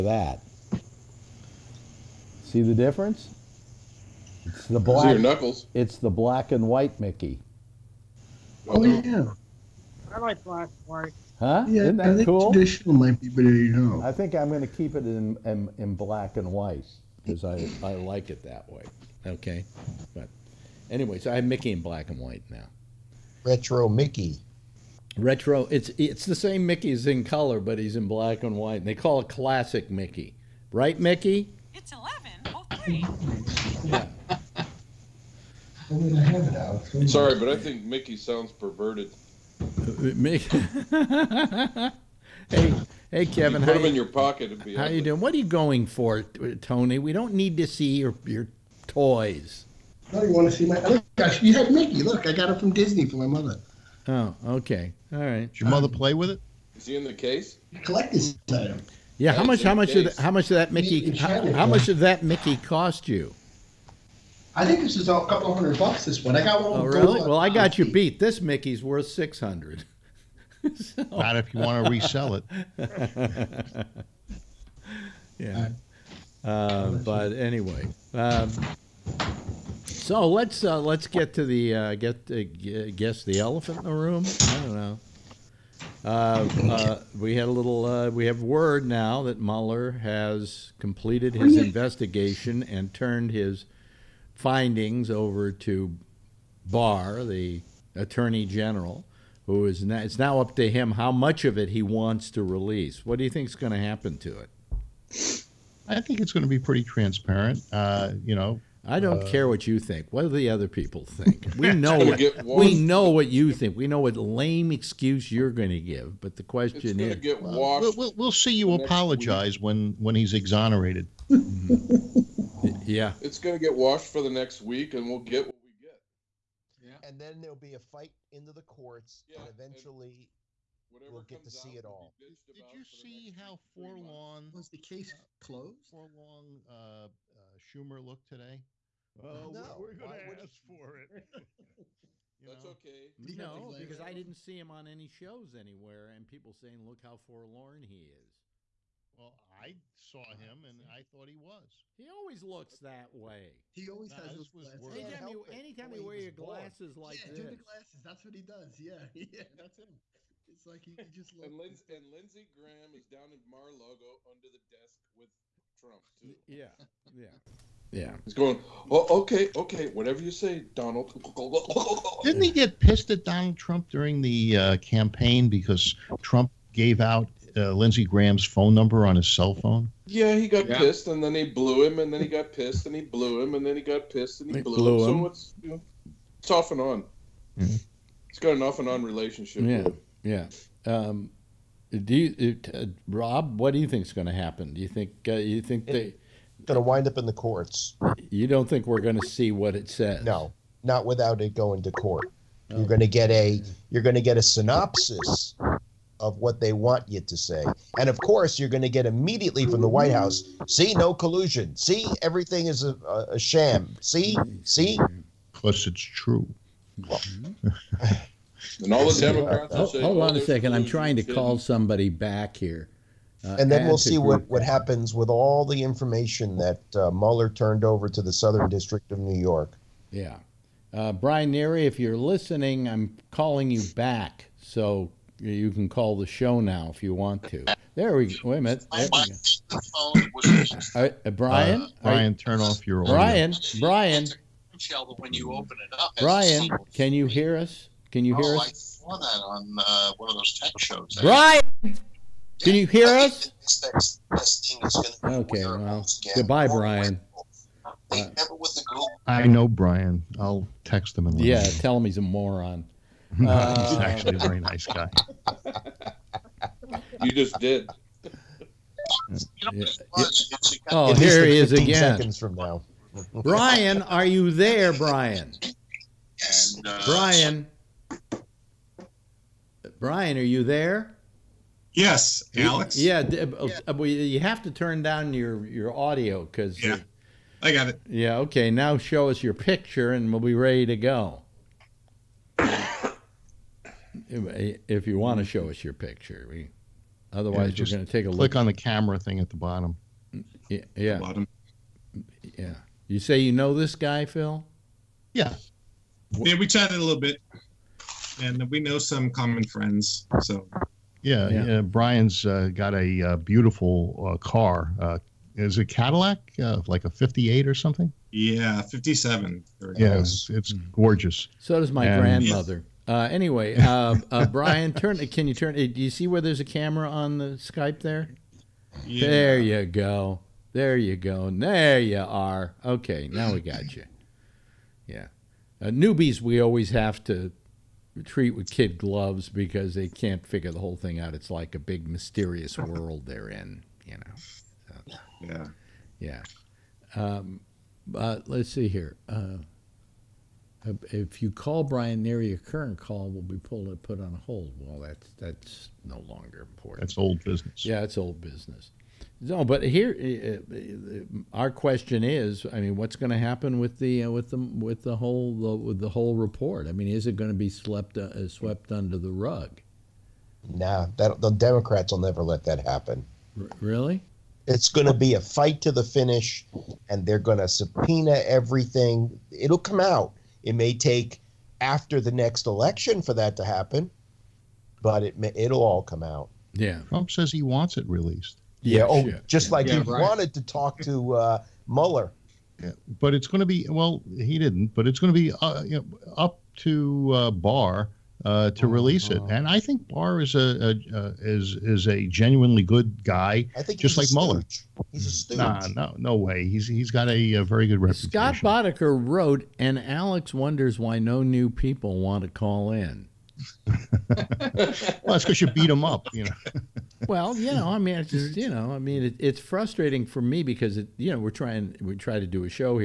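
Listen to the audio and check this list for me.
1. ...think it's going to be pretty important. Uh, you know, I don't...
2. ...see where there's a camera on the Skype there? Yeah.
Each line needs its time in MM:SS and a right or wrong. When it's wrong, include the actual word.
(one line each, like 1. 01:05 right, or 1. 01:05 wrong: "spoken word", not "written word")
1. 01:46 wrong: "transparent", not "important"
2. 05:26 right.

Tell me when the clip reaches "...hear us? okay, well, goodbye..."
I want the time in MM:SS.
04:12.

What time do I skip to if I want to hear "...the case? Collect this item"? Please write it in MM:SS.
00:57.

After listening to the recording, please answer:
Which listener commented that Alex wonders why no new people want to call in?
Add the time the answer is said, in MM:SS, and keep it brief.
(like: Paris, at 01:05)
Scott Boddicker, at 06:48.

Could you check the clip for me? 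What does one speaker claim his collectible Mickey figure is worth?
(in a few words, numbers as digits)
$600.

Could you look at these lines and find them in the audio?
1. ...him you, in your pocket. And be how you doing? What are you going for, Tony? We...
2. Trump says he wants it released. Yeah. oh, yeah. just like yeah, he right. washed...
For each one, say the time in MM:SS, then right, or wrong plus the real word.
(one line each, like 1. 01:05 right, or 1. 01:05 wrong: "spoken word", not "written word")
1. 00:43 right
2. 06:27 wrong: "wanted", not "washed".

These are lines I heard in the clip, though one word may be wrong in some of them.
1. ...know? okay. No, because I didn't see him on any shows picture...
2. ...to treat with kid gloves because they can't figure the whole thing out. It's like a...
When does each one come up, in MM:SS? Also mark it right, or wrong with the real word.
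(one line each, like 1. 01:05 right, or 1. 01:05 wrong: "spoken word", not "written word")
1. 02:22 wrong: "anywhere", not "picture"
2. 05:37 right.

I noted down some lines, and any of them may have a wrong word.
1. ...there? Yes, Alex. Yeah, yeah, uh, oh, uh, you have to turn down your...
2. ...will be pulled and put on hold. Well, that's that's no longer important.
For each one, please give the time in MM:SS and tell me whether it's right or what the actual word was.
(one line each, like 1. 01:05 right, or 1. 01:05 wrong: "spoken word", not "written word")
1. 04:40 right
2. 05:53 right.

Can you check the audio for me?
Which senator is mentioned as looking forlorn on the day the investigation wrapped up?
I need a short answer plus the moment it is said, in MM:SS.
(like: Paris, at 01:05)
Schumer, at 02:17.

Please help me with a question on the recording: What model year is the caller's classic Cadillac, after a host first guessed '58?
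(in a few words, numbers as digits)
1957.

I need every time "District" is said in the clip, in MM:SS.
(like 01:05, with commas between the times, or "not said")
03:48.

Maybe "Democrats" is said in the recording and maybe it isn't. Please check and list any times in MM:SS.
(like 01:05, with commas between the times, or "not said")
03:39, 06:11.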